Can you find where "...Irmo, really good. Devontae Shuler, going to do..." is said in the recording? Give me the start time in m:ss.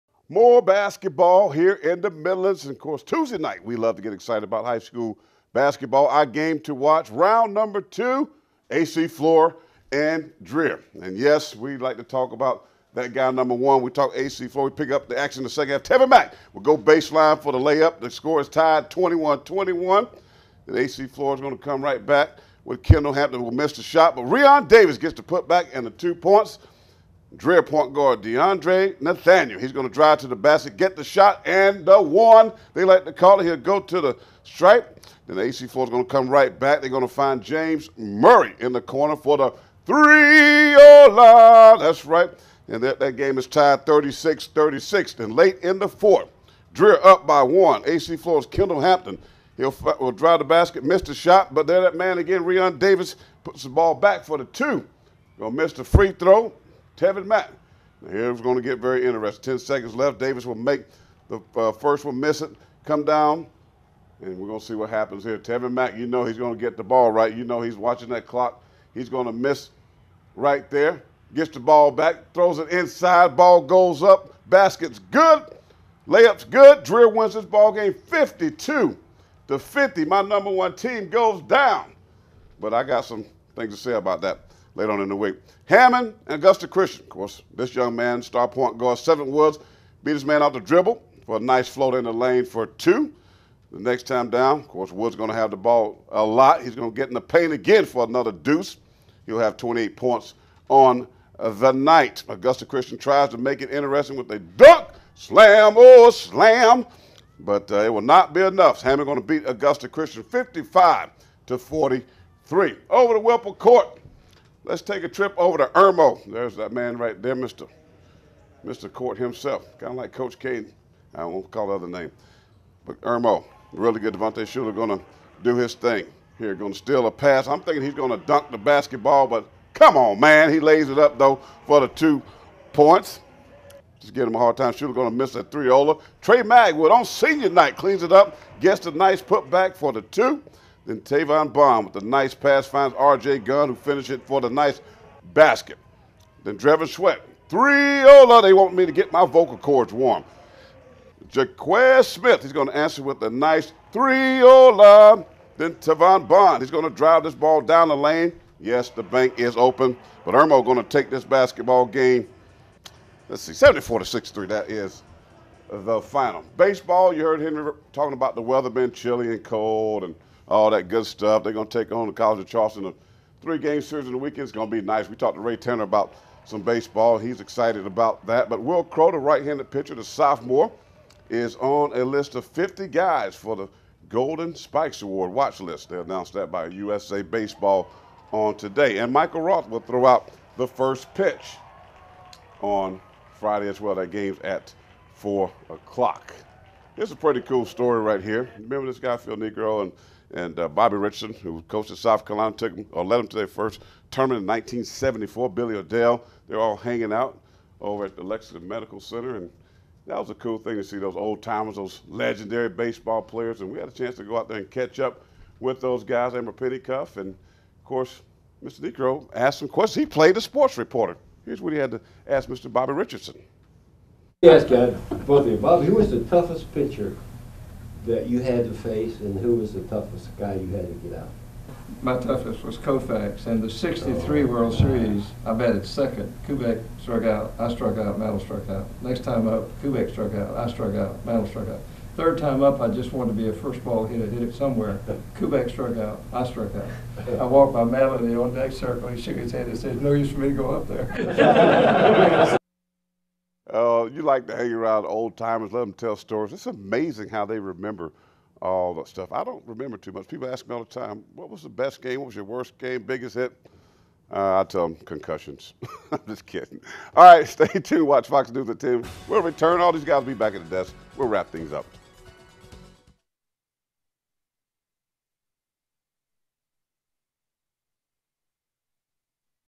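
2:03.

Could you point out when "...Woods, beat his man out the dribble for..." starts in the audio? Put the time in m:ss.
1:29.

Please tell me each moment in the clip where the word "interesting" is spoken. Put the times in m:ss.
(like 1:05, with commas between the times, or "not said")
0:59, 1:43.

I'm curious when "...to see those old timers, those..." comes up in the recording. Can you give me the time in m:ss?
3:30.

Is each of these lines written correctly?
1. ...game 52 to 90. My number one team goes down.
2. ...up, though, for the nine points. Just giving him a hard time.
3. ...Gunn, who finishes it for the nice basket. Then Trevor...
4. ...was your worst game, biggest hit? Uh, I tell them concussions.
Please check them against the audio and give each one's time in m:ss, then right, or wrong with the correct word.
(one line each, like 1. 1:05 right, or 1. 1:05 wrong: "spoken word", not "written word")
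1. 1:17 wrong: "50", not "90"
2. 2:10 wrong: "two", not "nine"
3. 2:23 right
4. 4:22 right.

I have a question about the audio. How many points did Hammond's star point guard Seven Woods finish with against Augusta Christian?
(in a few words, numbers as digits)
28.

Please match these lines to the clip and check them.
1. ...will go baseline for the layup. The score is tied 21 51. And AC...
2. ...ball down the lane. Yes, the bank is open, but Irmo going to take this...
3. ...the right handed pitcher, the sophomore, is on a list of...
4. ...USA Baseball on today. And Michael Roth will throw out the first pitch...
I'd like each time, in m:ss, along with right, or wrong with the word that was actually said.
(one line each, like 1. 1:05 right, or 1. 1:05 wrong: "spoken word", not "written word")
1. 0:16 wrong: "21", not "51"
2. 2:37 right
3. 2:59 right
4. 3:06 right.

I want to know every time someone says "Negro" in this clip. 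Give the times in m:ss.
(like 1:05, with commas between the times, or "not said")
3:19, 3:38.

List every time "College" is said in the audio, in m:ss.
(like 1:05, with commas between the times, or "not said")
2:52.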